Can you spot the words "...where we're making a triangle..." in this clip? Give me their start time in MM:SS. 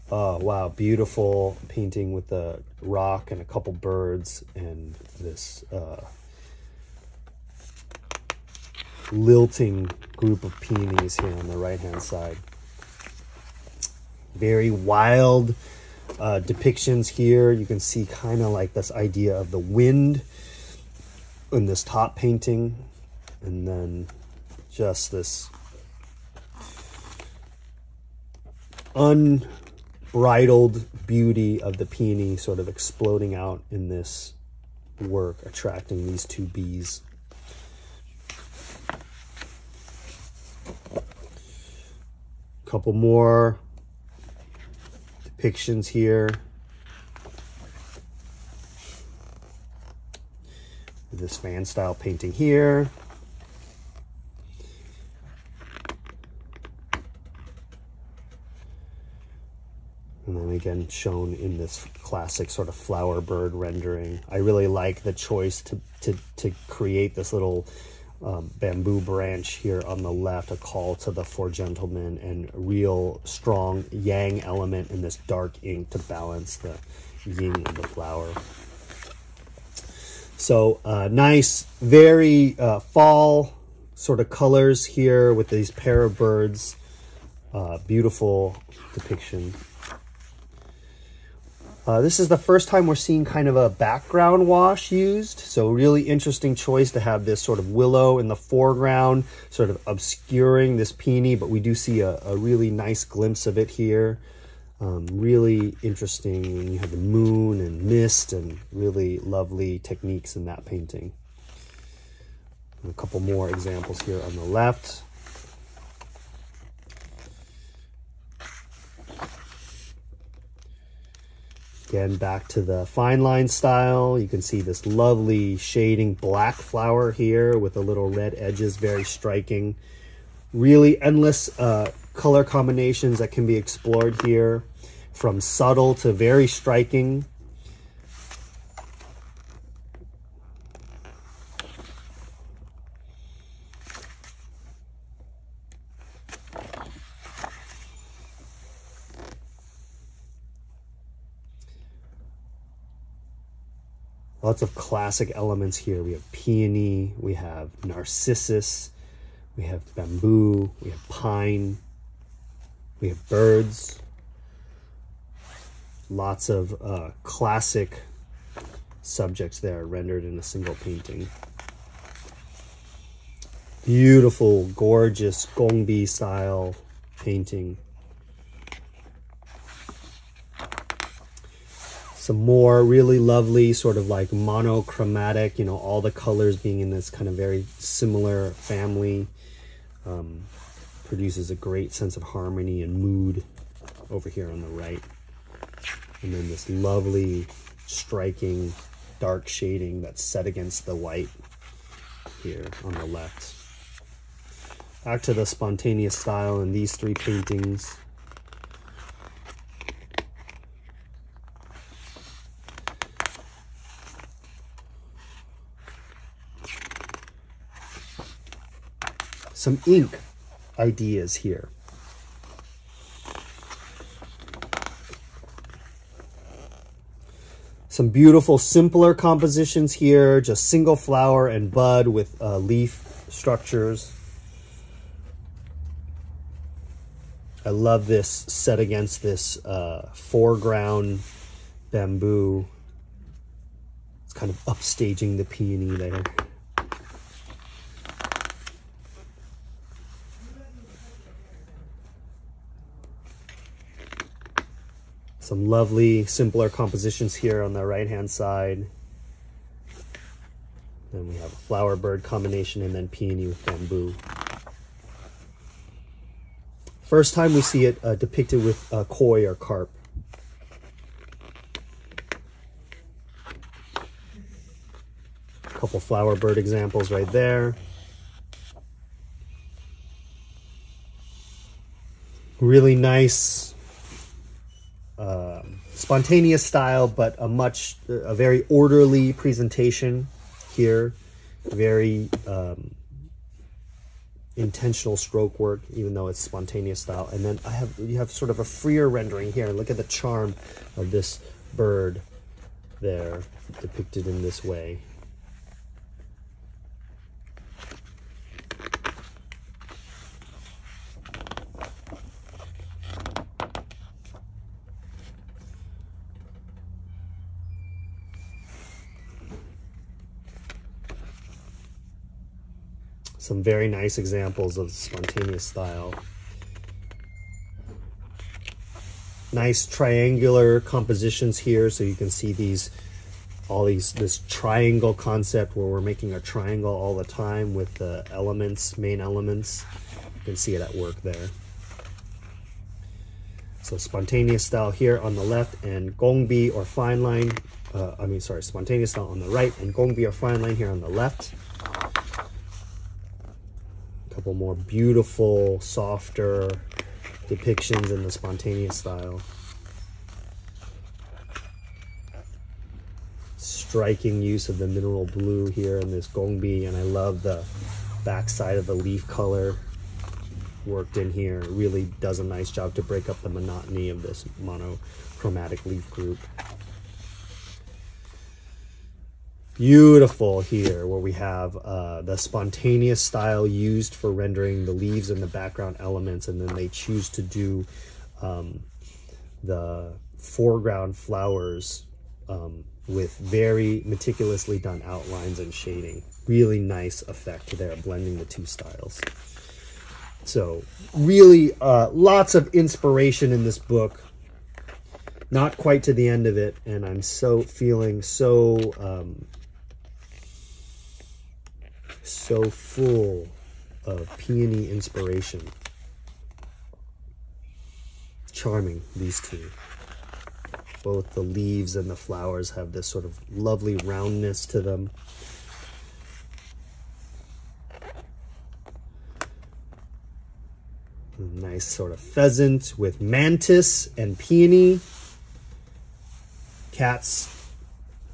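05:35.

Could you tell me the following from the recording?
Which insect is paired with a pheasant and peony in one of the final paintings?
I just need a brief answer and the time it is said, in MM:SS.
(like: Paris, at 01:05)
mantis, at 07:13.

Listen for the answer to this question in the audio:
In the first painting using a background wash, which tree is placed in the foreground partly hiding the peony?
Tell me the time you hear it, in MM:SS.
01:37.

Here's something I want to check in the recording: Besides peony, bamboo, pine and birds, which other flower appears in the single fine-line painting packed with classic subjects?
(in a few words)
narcissus.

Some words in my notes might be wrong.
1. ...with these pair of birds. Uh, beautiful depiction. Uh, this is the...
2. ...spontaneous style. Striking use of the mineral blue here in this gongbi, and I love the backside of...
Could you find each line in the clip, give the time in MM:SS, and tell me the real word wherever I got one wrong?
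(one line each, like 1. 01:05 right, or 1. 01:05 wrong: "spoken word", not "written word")
1. 01:25 right
2. 05:58 right.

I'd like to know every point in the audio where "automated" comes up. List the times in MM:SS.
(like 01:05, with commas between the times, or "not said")
not said.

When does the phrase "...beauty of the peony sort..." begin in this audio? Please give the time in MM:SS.
00:31.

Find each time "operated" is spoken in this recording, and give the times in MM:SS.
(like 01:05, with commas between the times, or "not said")
not said.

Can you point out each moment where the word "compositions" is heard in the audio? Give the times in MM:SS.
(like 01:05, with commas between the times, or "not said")
03:49, 04:16, 05:30.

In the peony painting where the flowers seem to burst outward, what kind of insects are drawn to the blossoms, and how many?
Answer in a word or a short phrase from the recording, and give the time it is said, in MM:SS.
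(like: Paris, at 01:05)
two bees, at 00:36.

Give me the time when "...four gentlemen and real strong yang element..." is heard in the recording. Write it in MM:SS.
01:11.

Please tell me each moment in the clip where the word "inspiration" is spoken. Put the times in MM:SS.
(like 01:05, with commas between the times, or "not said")
06:42, 06:54.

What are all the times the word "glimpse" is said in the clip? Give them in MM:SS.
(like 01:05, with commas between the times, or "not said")
01:43.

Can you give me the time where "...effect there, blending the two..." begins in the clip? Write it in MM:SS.
06:37.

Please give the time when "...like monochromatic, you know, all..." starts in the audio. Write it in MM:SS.
03:04.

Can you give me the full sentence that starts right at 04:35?
A couple flower bird examples right there.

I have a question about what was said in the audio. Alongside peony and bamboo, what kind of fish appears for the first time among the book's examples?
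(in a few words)
koi or carp.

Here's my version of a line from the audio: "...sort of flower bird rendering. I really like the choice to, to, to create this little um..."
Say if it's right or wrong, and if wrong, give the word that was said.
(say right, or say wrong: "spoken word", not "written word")
right.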